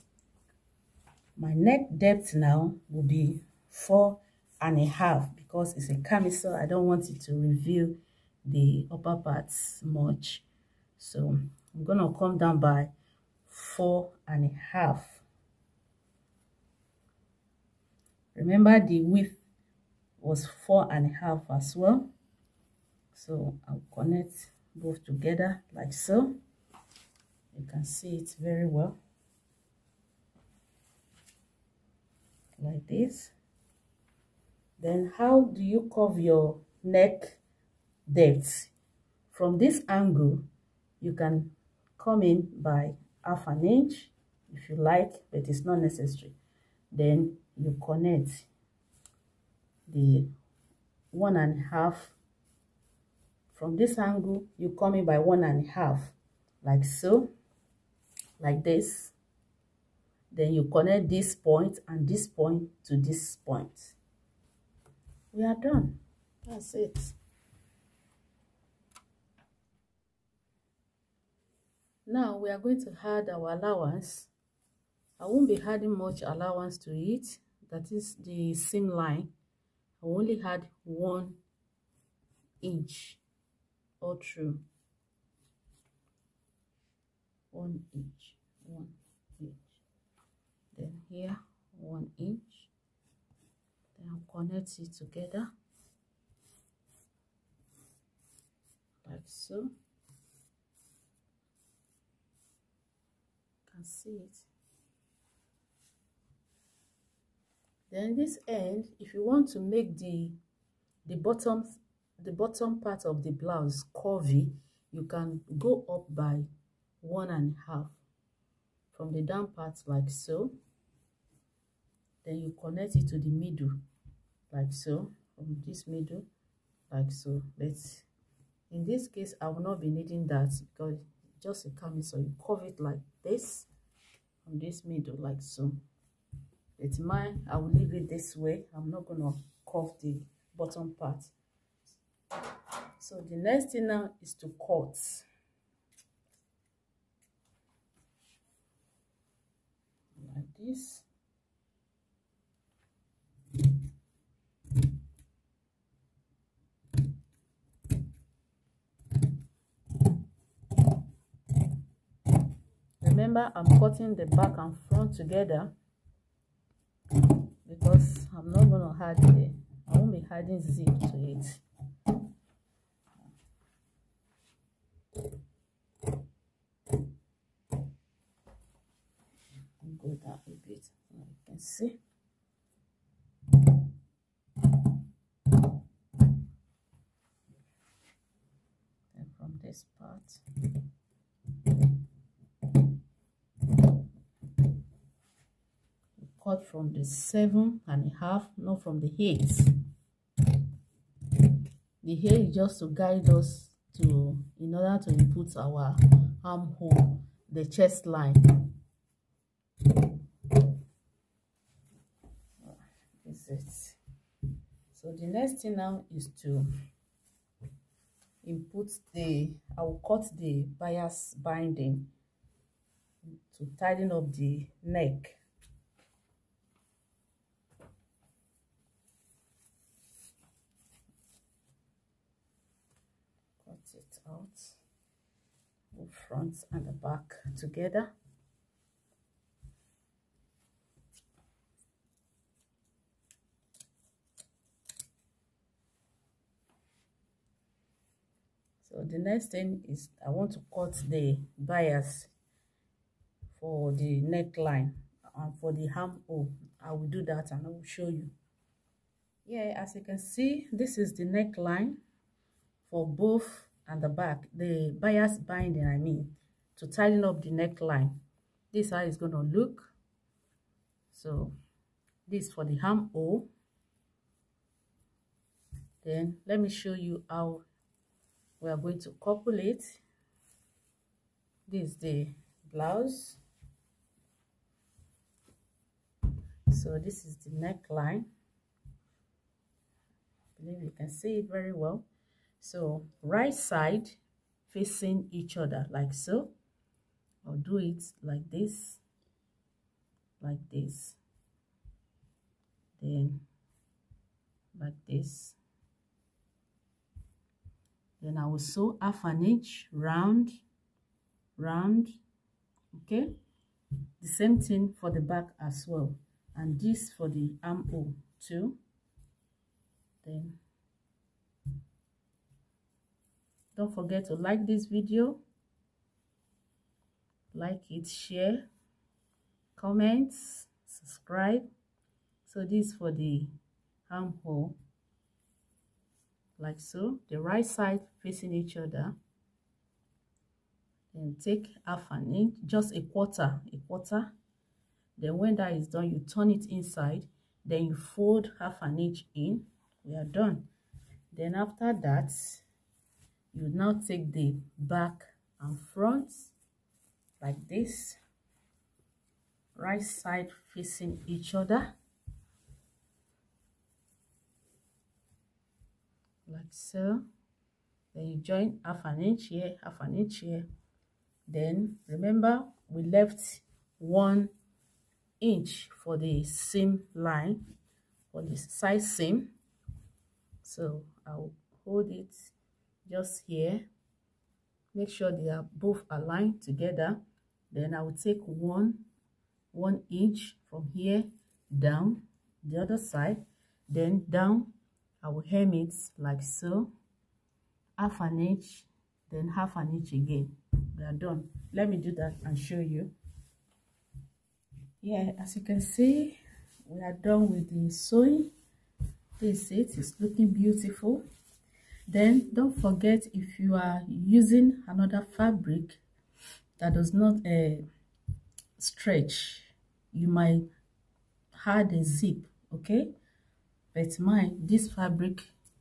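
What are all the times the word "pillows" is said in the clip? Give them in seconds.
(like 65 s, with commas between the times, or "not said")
not said.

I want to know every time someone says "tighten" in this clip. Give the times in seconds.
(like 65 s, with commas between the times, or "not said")
223 s, 266 s.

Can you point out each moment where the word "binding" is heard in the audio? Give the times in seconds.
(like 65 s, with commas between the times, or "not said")
221 s, 265 s.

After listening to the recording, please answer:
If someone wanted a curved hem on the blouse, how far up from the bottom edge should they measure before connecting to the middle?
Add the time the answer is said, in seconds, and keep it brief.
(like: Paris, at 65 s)
1 and a half, at 115 s.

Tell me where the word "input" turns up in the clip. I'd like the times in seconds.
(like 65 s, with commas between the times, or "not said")
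205 s, 218 s.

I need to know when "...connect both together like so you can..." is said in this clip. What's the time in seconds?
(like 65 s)
23 s.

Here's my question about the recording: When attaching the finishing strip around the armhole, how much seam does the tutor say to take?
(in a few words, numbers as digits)
a quarter.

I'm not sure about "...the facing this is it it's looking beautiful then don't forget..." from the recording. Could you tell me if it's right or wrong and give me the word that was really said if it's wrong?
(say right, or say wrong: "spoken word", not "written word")
wrong: "sewing", not "facing".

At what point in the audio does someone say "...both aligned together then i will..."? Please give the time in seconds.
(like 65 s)
385 s.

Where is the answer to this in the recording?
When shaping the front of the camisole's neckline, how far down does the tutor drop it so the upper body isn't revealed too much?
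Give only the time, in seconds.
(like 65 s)
12 s.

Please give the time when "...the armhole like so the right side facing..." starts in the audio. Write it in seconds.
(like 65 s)
333 s.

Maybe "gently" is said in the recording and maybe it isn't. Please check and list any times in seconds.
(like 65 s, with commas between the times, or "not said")
not said.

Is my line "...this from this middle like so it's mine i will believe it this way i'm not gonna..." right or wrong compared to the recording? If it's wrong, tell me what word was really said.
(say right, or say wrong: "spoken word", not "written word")
wrong: "leave", not "believe".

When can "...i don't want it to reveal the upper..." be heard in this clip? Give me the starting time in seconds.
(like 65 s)
6 s.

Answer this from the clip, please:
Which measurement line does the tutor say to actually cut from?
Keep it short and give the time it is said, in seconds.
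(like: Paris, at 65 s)
7 and a half, at 197 s.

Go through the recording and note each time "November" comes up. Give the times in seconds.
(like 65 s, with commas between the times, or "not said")
not said.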